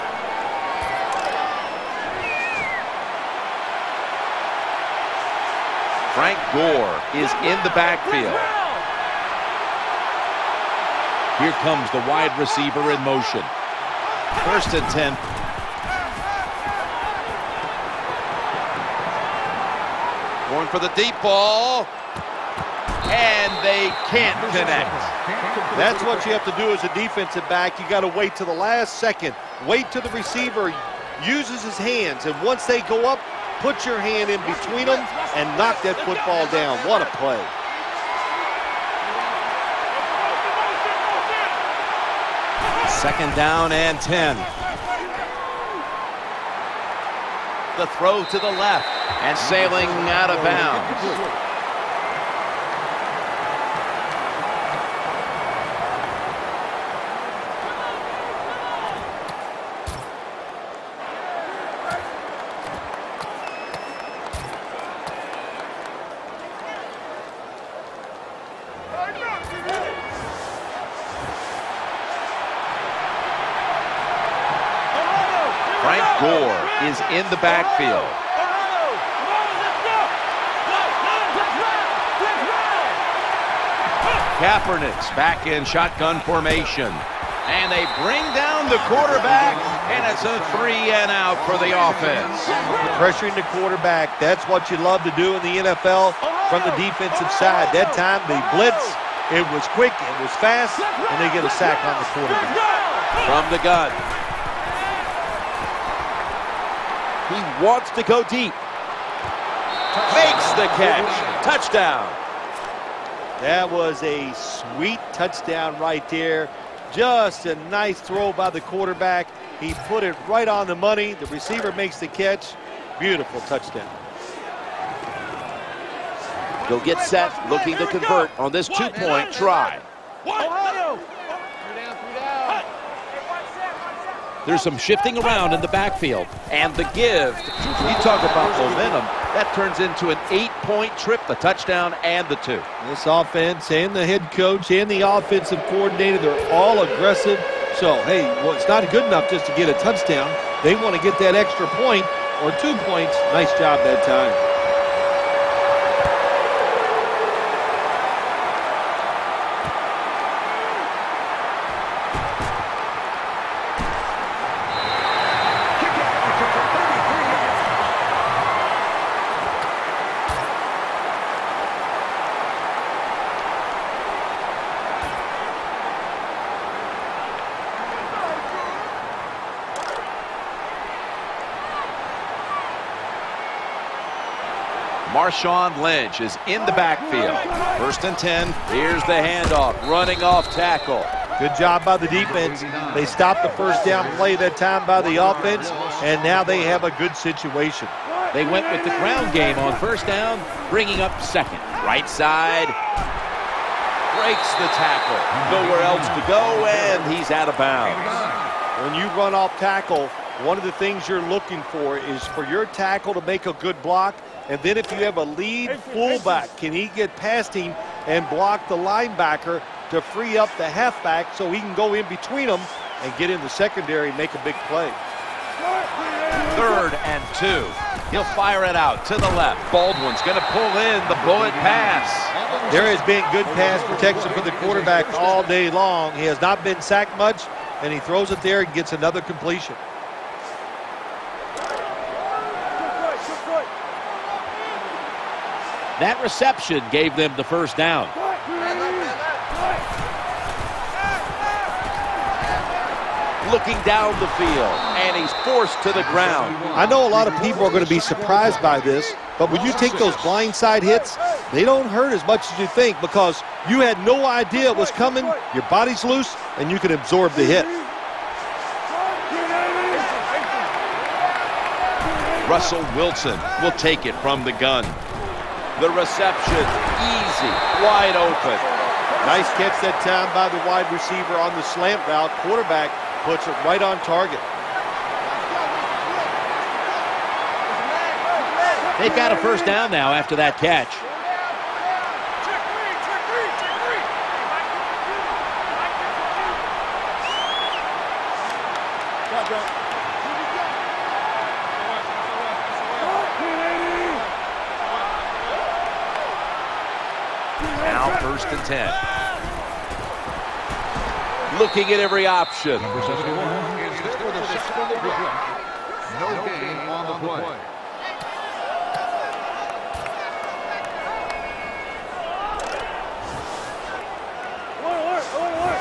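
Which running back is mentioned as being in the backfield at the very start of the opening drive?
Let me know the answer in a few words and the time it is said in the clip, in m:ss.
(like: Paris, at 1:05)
Frank Gore, at 0:06.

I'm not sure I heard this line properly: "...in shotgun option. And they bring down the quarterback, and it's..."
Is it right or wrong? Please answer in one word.
wrong.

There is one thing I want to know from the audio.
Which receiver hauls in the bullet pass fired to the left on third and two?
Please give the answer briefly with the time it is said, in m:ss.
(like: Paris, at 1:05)
Baldwin, at 3:49.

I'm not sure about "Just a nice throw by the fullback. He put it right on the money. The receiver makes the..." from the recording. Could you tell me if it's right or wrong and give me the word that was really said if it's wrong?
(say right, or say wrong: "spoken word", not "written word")
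wrong: "quarterback", not "fullback".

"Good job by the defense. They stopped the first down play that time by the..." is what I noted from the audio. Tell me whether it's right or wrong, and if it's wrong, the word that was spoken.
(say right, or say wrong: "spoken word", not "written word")
right.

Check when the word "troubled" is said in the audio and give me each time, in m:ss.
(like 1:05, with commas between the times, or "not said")
not said.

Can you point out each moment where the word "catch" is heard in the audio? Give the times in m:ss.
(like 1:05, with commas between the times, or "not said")
1:50, 2:02, 4:39, 4:50.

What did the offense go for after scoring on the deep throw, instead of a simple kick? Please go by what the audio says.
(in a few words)
two-point try.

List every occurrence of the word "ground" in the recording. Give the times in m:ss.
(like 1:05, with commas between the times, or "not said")
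3:18, 4:16.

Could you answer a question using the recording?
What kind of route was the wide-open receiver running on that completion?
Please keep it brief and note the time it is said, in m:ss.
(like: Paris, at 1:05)
slant route, at 4:41.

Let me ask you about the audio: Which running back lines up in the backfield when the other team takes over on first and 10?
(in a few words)
Marshawn Lynch.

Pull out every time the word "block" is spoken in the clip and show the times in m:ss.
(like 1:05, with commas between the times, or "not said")
3:33, 3:38.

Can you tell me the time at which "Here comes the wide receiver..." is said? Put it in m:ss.
0:11.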